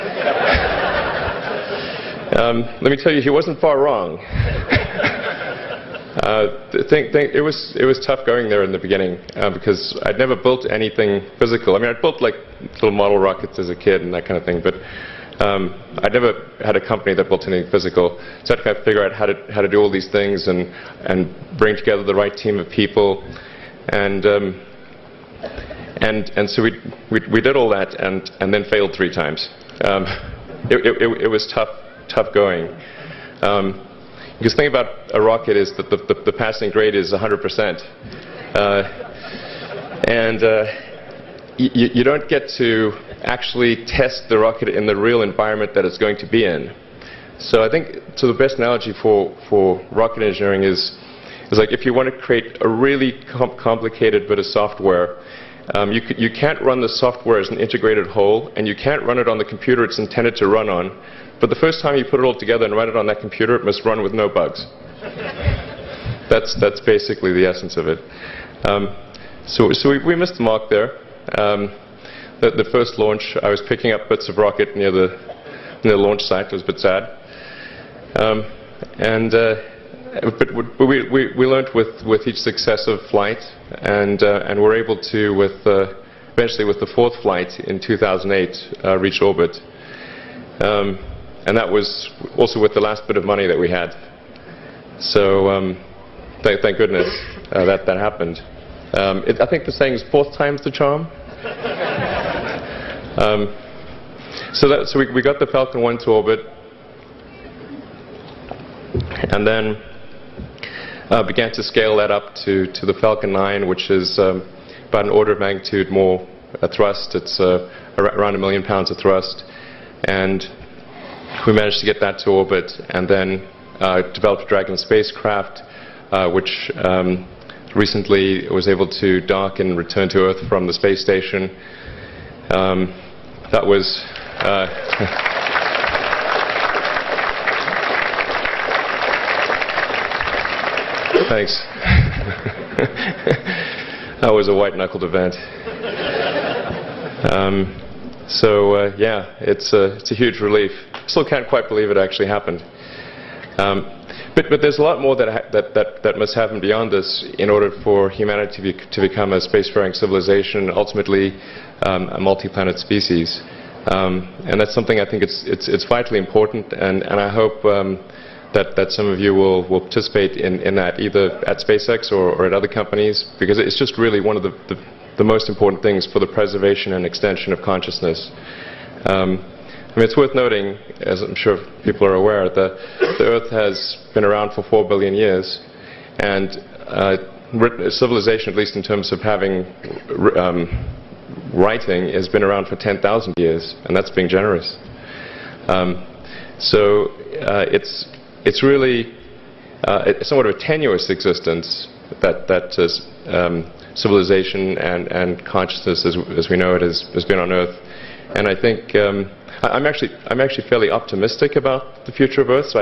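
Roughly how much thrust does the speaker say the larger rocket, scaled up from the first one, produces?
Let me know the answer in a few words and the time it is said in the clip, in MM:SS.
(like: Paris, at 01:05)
1 million pounds, at 01:58.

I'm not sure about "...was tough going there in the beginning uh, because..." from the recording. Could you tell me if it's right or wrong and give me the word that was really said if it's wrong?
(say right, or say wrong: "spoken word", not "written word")
right.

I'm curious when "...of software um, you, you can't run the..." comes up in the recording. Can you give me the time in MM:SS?
00:54.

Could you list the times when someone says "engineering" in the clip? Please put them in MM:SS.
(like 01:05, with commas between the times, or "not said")
00:50.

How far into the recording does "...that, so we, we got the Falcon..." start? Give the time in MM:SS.
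01:44.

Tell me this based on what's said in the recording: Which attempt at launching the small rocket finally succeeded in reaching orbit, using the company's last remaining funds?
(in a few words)
fourth flight.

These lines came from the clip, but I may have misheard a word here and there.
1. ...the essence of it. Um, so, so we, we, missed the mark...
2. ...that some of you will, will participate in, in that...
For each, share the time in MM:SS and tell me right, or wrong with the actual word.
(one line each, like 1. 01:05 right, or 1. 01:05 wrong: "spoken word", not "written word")
1. 01:07 right
2. 02:48 right.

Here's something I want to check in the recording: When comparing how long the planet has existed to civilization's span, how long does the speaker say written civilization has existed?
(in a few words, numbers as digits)
10,000 years.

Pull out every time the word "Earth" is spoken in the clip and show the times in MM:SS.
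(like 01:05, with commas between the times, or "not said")
02:10, 03:03, 03:27.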